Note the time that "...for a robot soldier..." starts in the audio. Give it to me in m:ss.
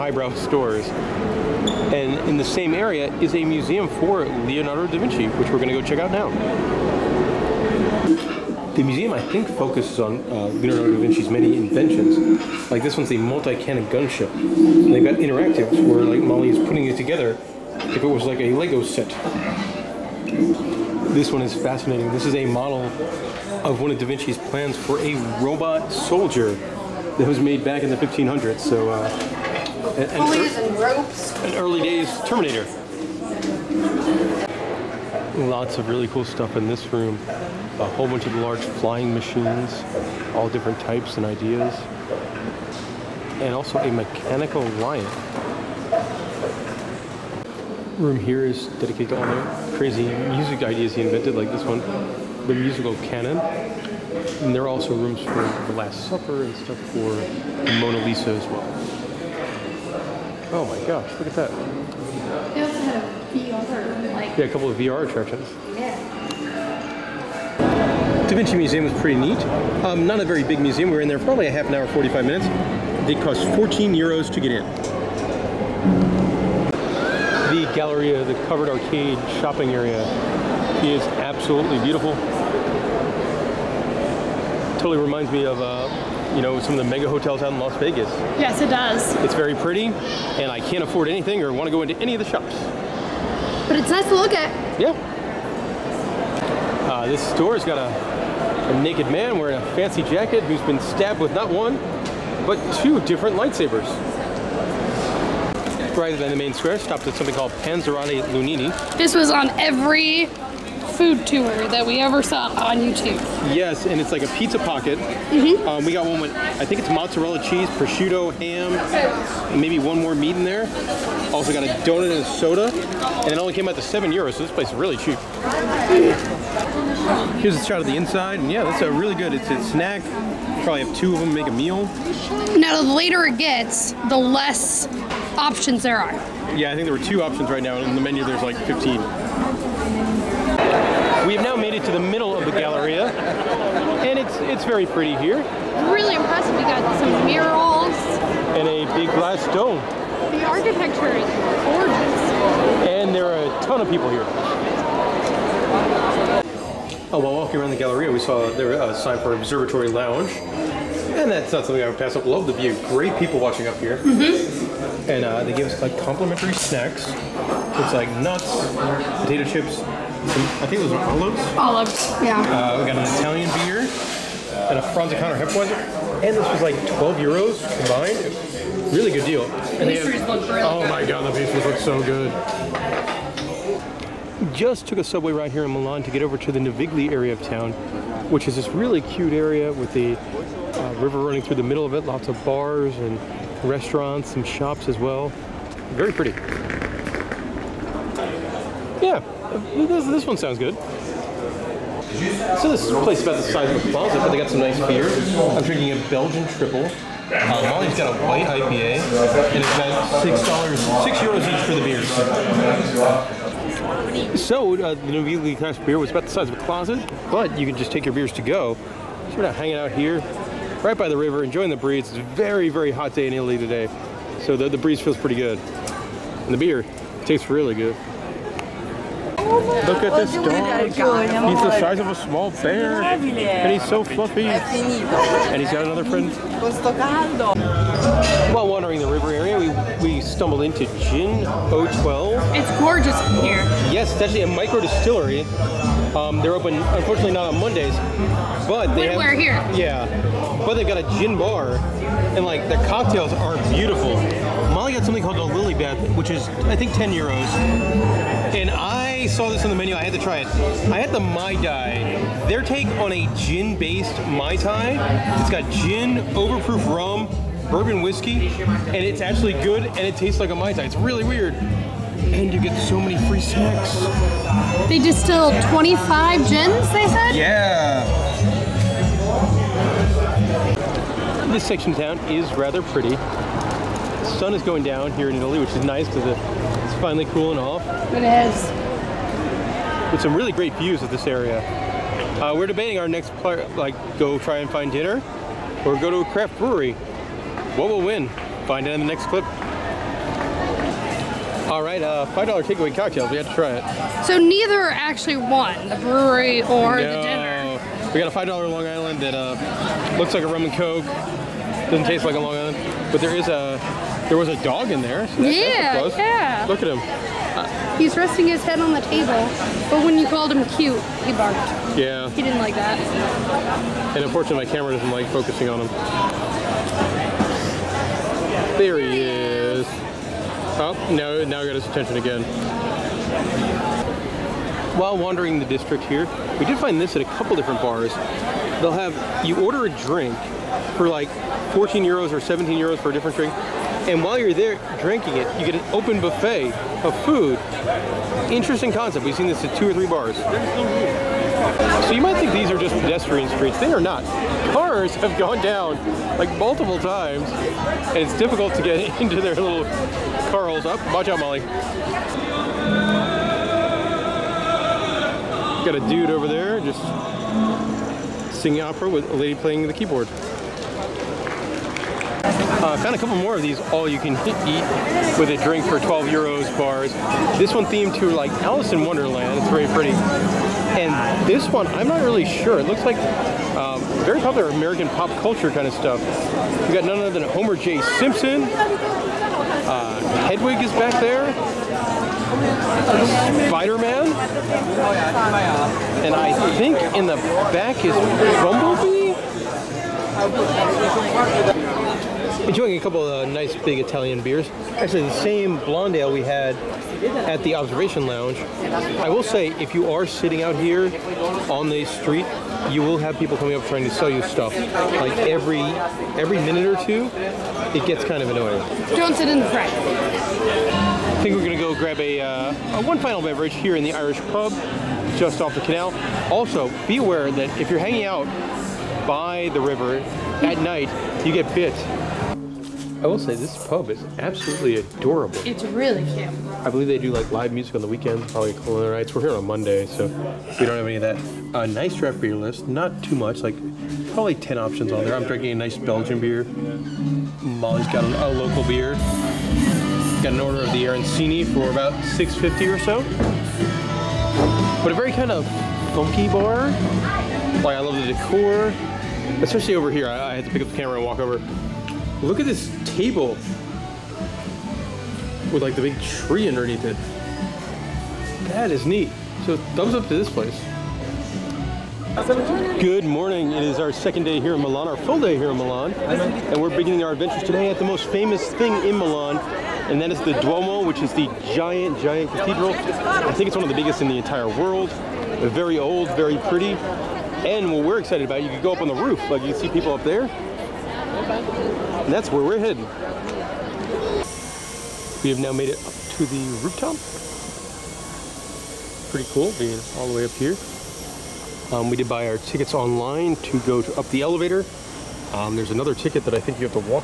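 0:24.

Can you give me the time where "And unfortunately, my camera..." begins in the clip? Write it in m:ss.
5:24.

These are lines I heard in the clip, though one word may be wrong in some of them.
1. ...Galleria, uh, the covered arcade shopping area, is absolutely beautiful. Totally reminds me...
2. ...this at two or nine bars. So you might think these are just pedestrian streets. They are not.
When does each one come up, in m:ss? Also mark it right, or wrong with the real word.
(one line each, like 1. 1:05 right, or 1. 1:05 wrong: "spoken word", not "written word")
1. 1:17 right
2. 5:49 wrong: "three", not "nine".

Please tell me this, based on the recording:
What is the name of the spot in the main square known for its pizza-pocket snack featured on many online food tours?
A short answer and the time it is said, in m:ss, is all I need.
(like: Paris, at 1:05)
Panzerotti Luini, at 1:47.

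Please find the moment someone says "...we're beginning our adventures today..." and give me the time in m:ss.
7:56.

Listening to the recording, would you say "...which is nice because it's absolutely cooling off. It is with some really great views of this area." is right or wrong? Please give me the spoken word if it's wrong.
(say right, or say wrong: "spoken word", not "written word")
wrong: "finally", not "absolutely".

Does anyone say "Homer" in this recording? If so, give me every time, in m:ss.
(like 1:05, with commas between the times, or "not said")
6:27.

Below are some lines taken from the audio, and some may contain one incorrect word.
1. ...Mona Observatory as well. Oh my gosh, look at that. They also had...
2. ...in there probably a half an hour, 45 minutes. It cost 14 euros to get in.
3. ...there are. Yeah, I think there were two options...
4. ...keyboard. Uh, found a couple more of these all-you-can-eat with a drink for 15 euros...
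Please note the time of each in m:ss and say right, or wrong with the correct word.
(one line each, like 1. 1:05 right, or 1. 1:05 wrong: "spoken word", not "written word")
1. 0:57 wrong: "Lisa", not "Observatory"
2. 1:11 right
3. 2:15 right
4. 6:09 wrong: "12", not "15".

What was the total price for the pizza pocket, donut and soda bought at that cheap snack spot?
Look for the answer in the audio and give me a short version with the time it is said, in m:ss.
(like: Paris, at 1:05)
7 euros, at 2:03.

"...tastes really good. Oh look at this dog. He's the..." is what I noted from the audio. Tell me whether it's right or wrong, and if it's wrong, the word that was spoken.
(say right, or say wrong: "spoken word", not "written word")
right.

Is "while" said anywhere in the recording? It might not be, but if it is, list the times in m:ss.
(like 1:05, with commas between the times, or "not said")
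2:37, 3:58, 5:34, 5:44.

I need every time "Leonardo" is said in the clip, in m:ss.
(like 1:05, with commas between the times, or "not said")
0:04, 0:10.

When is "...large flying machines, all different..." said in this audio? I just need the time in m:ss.
0:38.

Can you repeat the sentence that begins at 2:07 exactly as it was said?
Here's a shot of the inside, and yeah, that's a really good.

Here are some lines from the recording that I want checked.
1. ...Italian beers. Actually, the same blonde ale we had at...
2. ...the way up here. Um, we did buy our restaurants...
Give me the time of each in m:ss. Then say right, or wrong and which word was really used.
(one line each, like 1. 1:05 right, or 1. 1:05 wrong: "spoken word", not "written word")
1. 6:43 right
2. 8:20 wrong: "tickets", not "restaurants".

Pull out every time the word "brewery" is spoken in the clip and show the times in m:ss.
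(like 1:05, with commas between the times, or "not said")
4:56, 5:05.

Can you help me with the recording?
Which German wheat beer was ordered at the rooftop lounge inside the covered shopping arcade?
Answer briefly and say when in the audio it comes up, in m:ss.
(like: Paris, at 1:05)
Franziskaner Hefeweizen, at 2:54.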